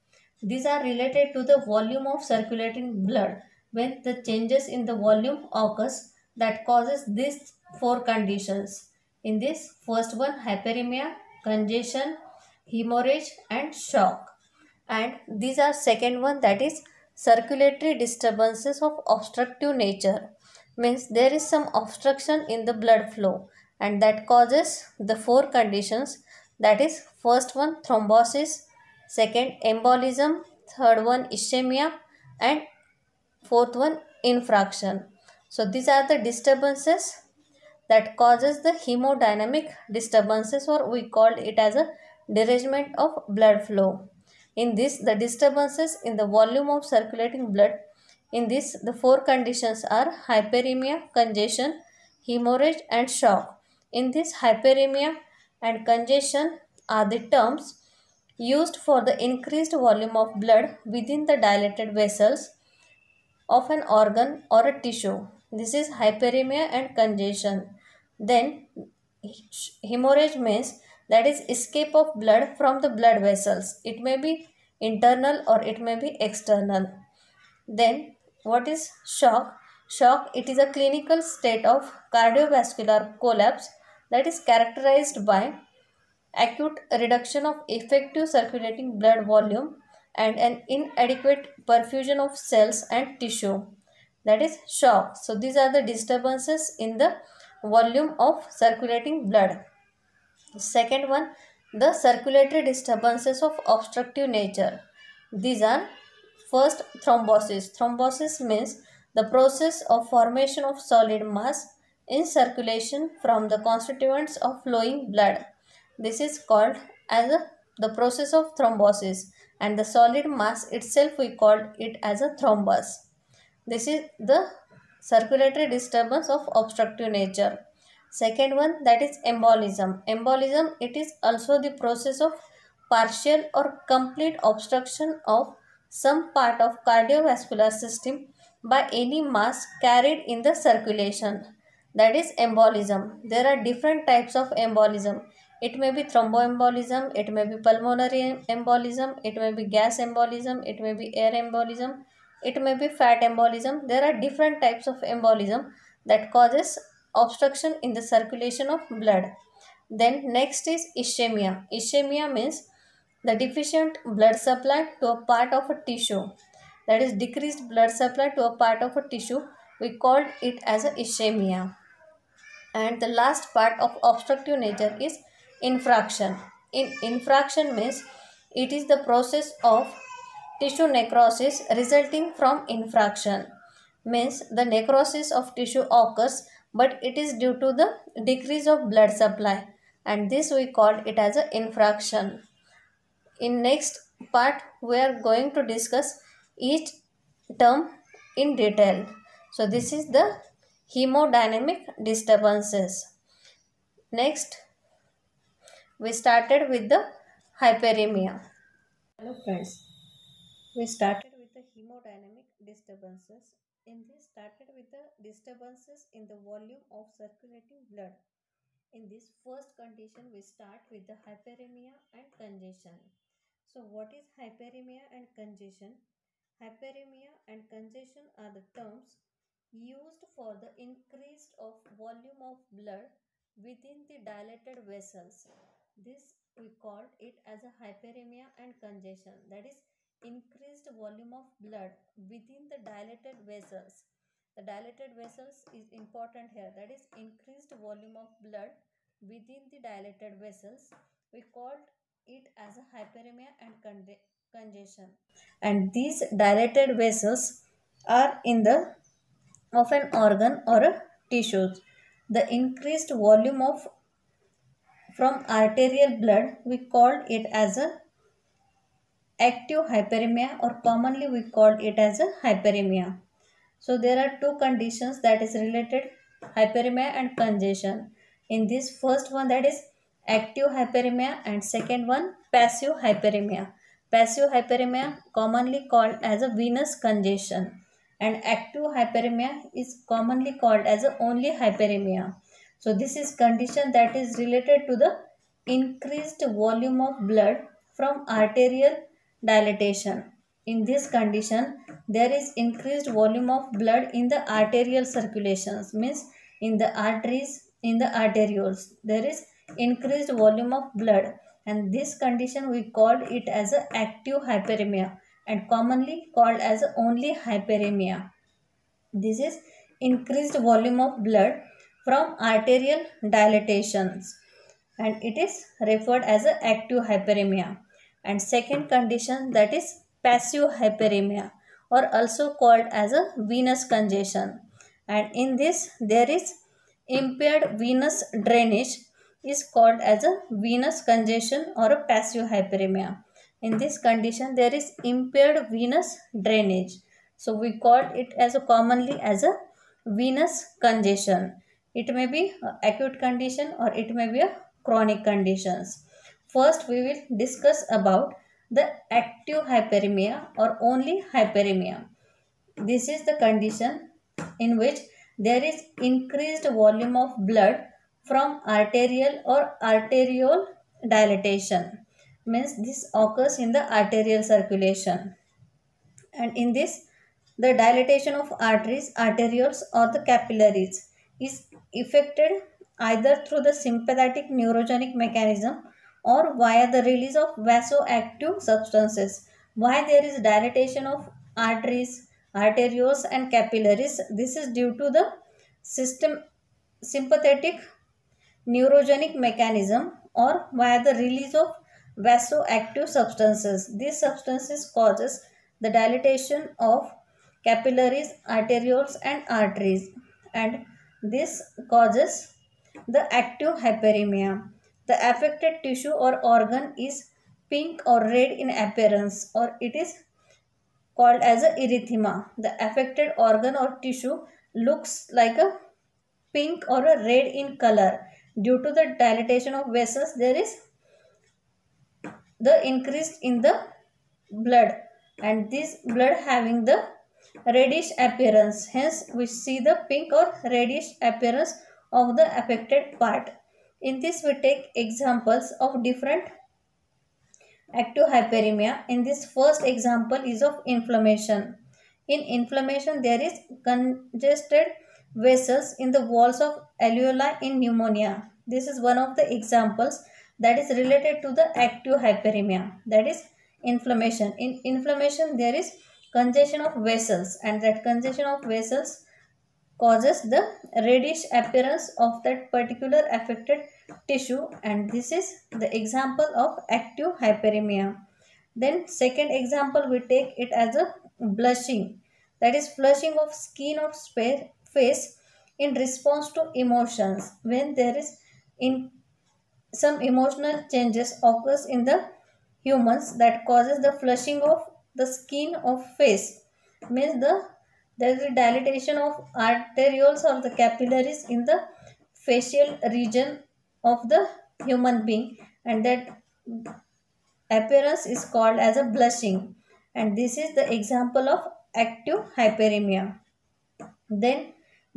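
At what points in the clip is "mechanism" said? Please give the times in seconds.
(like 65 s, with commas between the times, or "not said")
385 s, 399 s.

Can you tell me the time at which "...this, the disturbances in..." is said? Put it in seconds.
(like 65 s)
44 s.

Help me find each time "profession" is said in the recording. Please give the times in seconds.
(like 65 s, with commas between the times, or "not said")
not said.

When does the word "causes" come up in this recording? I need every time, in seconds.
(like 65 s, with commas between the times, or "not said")
6 s, 24 s, 38 s, 156 s, 404 s, 411 s, 470 s, 493 s.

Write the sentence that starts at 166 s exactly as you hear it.
That is decreased blood supply to a part of a tissue.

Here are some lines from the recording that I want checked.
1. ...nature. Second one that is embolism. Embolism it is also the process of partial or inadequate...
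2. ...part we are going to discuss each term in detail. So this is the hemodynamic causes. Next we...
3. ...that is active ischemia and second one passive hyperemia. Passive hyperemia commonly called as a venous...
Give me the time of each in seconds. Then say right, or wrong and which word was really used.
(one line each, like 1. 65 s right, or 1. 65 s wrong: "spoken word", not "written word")
1. 127 s wrong: "complete", not "inadequate"
2. 194 s wrong: "disturbances", not "causes"
3. 279 s wrong: "hyperemia", not "ischemia".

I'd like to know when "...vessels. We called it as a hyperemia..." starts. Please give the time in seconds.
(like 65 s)
250 s.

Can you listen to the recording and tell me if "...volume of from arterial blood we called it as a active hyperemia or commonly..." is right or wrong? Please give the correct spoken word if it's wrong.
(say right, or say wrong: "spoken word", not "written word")
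right.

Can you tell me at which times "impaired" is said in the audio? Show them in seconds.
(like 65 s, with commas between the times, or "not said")
337 s, 345 s.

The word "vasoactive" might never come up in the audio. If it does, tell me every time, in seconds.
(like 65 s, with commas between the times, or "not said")
387 s, 402 s.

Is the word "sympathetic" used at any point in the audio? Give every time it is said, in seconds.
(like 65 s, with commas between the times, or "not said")
383 s, 397 s.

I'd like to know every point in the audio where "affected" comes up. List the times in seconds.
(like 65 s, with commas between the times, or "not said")
415 s, 422 s, 442 s, 473 s.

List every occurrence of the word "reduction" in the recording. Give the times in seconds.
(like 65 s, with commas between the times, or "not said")
86 s.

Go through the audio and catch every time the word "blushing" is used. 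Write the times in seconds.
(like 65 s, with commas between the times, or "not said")
481 s, 509 s.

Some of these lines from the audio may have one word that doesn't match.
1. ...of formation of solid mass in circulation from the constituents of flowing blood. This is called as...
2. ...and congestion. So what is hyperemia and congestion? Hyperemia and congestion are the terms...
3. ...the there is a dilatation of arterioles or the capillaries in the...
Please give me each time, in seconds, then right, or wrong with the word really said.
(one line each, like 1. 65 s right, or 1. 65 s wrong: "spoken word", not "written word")
1. 109 s right
2. 222 s right
3. 497 s right.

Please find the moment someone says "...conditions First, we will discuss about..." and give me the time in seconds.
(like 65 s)
355 s.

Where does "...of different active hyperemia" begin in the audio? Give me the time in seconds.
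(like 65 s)
445 s.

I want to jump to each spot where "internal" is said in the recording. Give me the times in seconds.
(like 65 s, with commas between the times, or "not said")
74 s.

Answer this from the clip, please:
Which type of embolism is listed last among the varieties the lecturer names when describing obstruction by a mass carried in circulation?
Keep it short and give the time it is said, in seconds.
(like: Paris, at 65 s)
Fat embolism, at 152 s.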